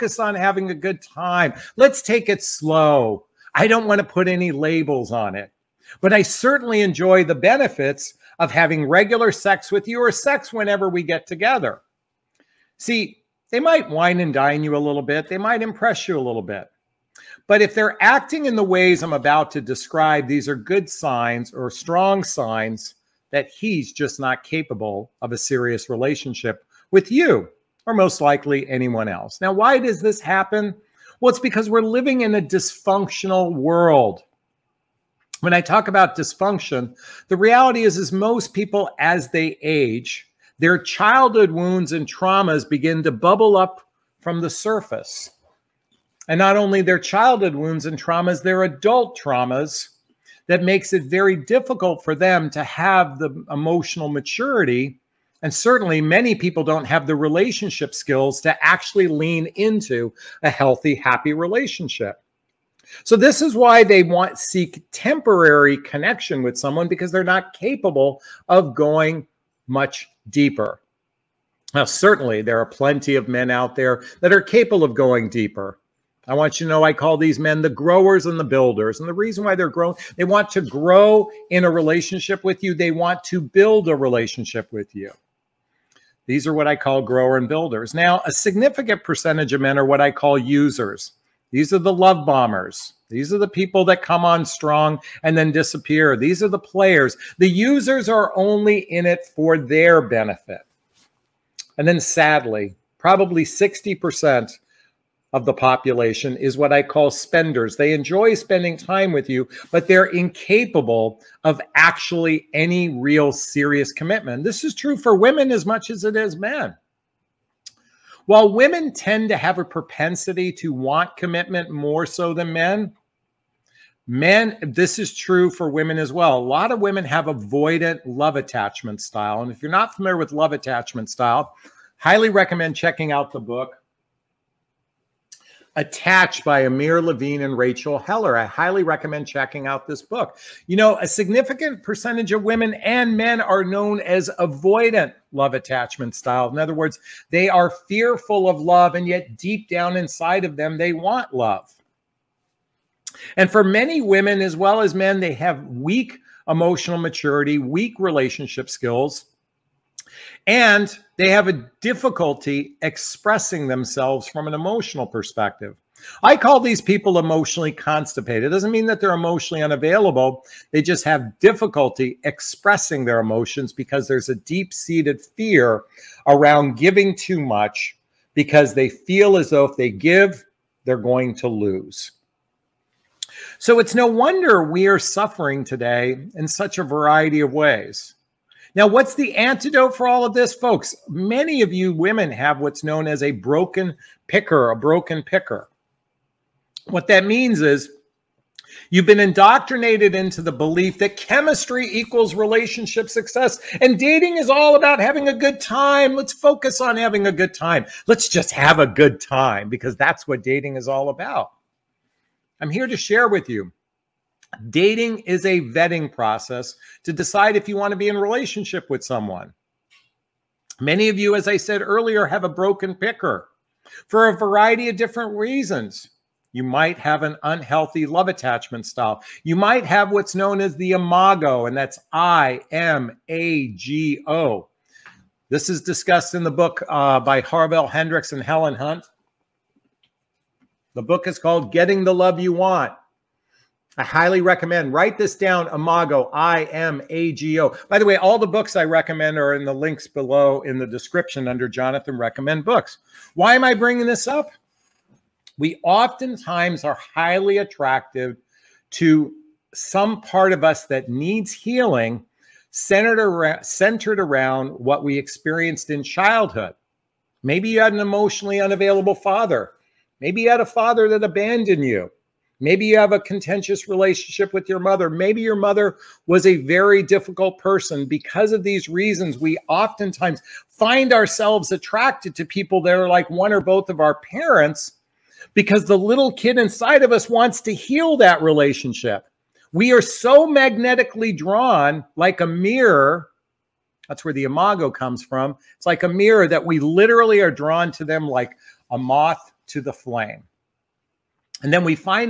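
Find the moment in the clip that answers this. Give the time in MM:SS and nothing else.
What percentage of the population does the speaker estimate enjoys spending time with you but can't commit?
01:43.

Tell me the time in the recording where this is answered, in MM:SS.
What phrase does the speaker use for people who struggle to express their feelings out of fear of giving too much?
02:47.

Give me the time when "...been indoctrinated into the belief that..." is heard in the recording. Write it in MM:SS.
03:19.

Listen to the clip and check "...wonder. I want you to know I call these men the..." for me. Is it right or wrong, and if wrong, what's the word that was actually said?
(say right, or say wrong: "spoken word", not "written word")
wrong: "deeper", not "wonder".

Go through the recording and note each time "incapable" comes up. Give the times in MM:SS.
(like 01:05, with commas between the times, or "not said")
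01:50.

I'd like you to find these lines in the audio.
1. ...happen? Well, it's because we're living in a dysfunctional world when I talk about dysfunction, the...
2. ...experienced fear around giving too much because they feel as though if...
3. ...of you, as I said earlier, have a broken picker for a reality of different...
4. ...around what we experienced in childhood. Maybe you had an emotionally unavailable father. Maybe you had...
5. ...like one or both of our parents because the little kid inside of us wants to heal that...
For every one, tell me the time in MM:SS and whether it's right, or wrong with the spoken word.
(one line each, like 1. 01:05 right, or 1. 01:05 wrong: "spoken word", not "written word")
1. 00:30 right
2. 02:54 wrong: "seated", not "experienced"
3. 03:41 wrong: "variety", not "reality"
4. 04:24 right
5. 04:43 right.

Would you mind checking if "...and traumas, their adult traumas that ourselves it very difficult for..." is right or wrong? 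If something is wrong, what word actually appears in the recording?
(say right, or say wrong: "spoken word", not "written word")
wrong: "makes", not "ourselves".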